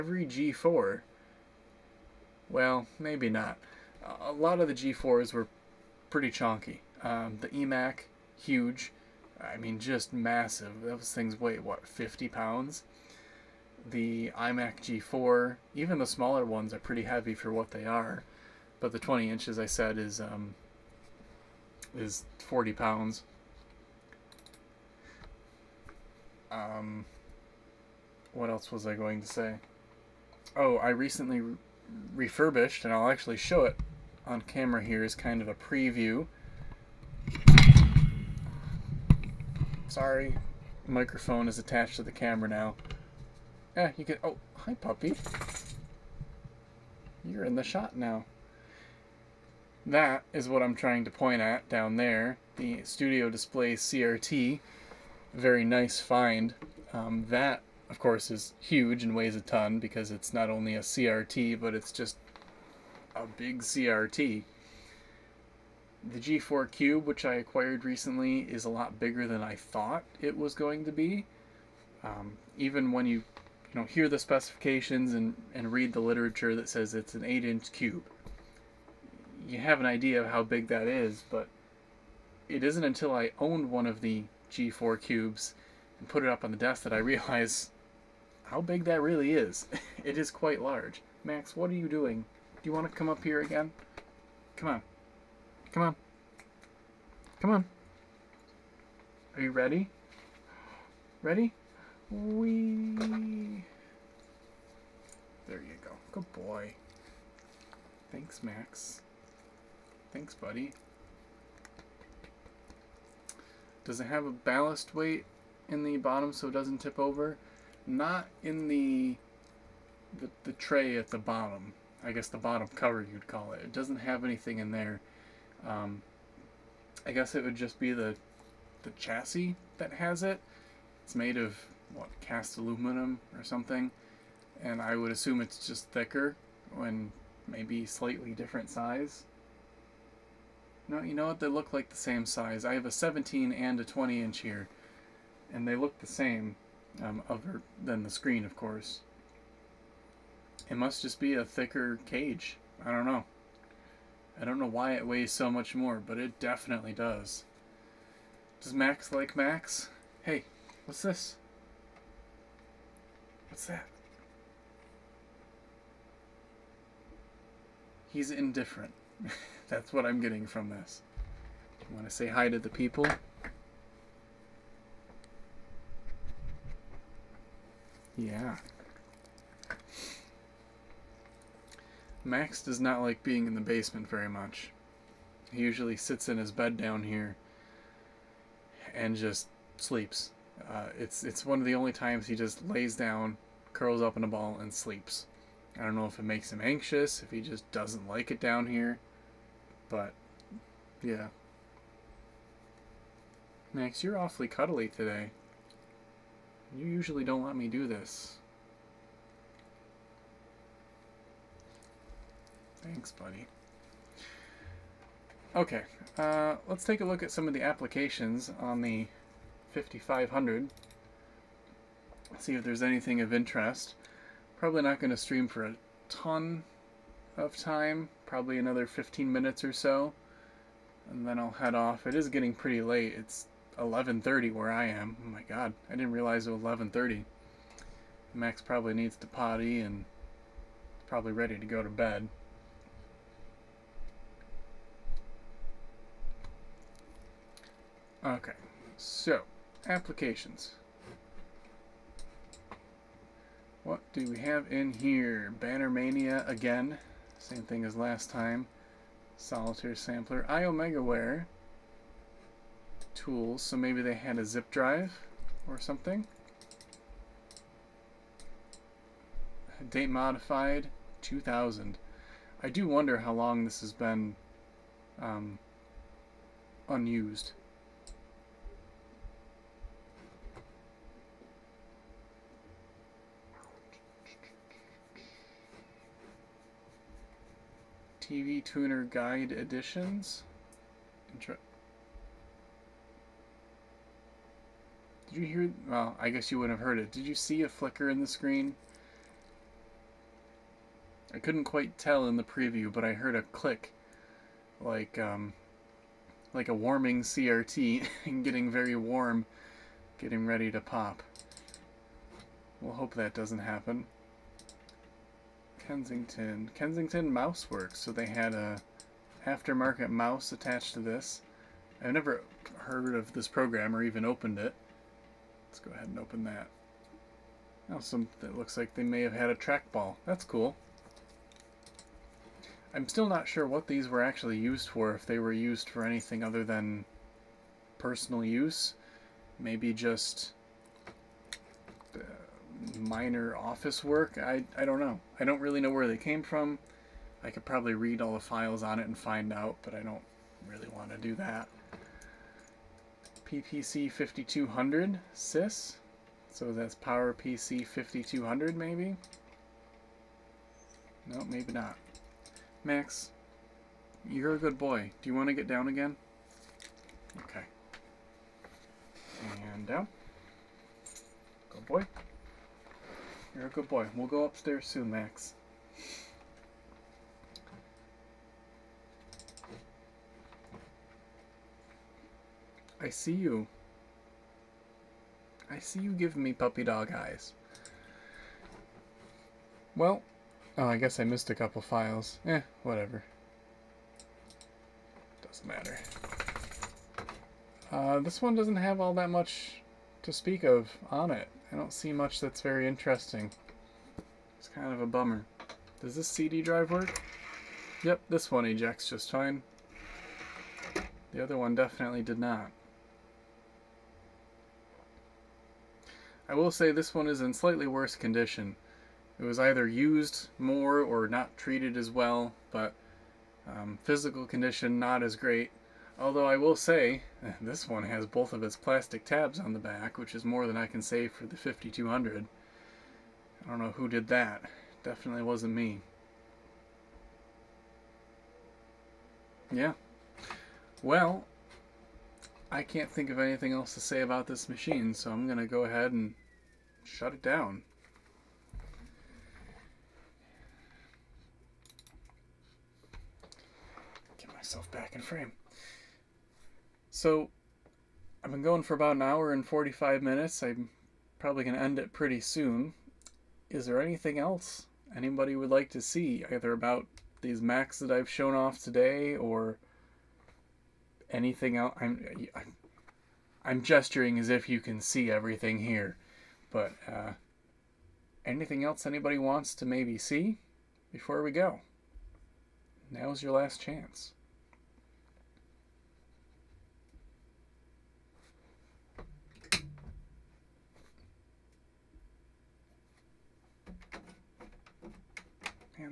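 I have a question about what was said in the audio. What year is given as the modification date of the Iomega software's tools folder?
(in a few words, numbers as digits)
2000.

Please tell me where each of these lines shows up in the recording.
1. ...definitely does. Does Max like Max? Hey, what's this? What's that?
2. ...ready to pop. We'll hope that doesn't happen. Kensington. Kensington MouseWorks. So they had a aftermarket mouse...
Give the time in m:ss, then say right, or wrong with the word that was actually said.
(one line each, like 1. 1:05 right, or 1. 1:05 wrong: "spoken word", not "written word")
1. 2:36 right
2. 5:10 right.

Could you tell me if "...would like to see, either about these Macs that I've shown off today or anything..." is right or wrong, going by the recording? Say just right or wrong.
right.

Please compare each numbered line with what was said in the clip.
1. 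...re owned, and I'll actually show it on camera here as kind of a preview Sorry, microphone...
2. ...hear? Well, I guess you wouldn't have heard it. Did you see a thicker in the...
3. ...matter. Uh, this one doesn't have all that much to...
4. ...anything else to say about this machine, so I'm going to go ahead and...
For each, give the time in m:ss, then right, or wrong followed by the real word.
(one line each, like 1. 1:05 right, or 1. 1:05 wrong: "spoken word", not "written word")
1. 0:31 wrong: "refurbished", not "owned"
2. 4:55 wrong: "flicker", not "thicker"
3. 6:35 right
4. 7:23 right.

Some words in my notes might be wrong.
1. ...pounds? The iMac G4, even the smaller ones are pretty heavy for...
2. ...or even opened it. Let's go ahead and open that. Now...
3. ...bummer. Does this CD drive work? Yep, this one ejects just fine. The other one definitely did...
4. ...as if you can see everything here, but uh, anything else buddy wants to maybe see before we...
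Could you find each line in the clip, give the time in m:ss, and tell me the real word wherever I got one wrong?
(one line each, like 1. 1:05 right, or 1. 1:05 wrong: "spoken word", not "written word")
1. 0:12 right
2. 5:23 right
3. 6:45 right
4. 7:54 wrong: "anybody", not "buddy".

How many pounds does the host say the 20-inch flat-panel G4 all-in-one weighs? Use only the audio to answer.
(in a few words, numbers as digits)
40.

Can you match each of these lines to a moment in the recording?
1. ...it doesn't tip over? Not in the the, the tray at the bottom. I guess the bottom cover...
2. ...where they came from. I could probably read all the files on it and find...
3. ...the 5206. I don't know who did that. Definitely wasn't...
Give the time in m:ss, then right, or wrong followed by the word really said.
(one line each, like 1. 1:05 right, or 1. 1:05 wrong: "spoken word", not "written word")
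1. 1:56 right
2. 5:45 right
3. 7:11 wrong: "5200", not "5206".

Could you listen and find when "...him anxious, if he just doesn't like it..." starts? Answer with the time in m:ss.
3:16.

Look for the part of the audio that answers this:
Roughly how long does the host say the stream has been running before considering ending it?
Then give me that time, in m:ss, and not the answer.
7:39.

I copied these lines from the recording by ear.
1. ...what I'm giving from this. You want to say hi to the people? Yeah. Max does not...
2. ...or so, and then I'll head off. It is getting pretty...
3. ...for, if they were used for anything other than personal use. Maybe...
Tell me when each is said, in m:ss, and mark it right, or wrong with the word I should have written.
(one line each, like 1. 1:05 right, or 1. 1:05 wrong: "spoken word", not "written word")
1. 2:49 wrong: "getting", not "giving"
2. 3:49 right
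3. 5:34 right.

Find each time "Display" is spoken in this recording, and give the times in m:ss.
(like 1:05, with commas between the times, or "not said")
0:53.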